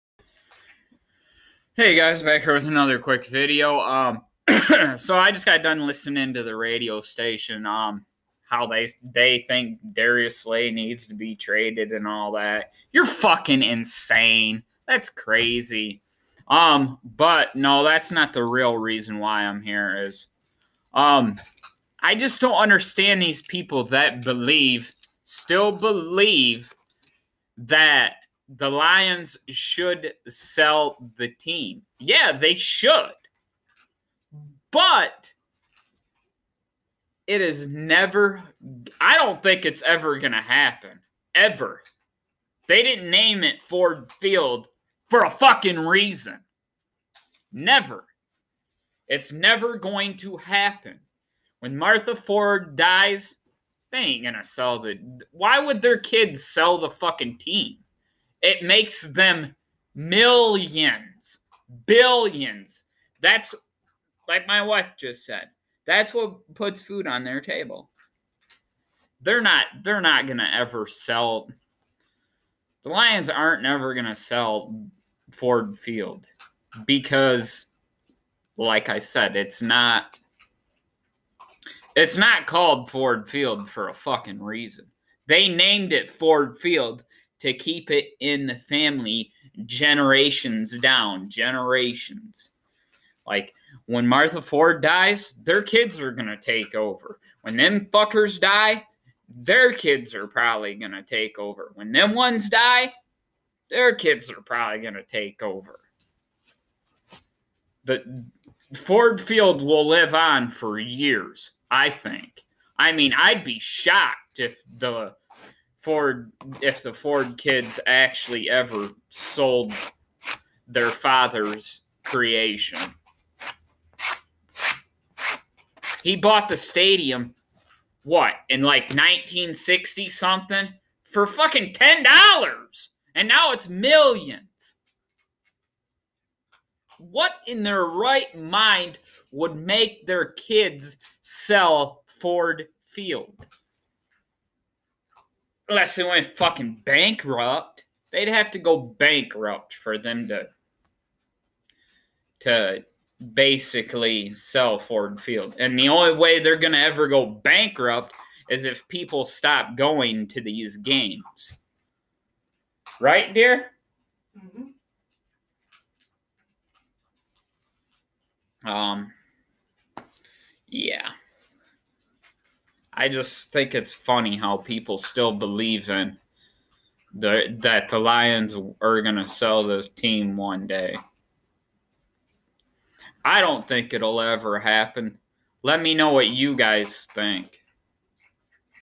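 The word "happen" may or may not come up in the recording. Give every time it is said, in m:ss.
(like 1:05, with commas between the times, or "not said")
0:40, 0:50, 3:04.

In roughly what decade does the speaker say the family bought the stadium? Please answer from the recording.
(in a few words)
1960s.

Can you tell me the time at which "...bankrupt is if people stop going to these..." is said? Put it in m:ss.
2:37.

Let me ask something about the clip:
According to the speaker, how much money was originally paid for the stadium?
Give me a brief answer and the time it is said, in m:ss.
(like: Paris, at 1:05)
$10, at 2:11.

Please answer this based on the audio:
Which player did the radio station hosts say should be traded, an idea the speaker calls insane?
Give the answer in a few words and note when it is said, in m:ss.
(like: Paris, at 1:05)
Darius Slay, at 0:09.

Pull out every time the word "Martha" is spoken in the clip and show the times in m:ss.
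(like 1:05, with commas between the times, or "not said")
0:51, 1:34.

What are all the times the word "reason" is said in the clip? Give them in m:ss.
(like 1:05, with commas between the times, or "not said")
0:18, 0:45, 1:24.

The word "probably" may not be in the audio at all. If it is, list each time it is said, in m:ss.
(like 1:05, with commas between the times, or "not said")
1:40, 1:44.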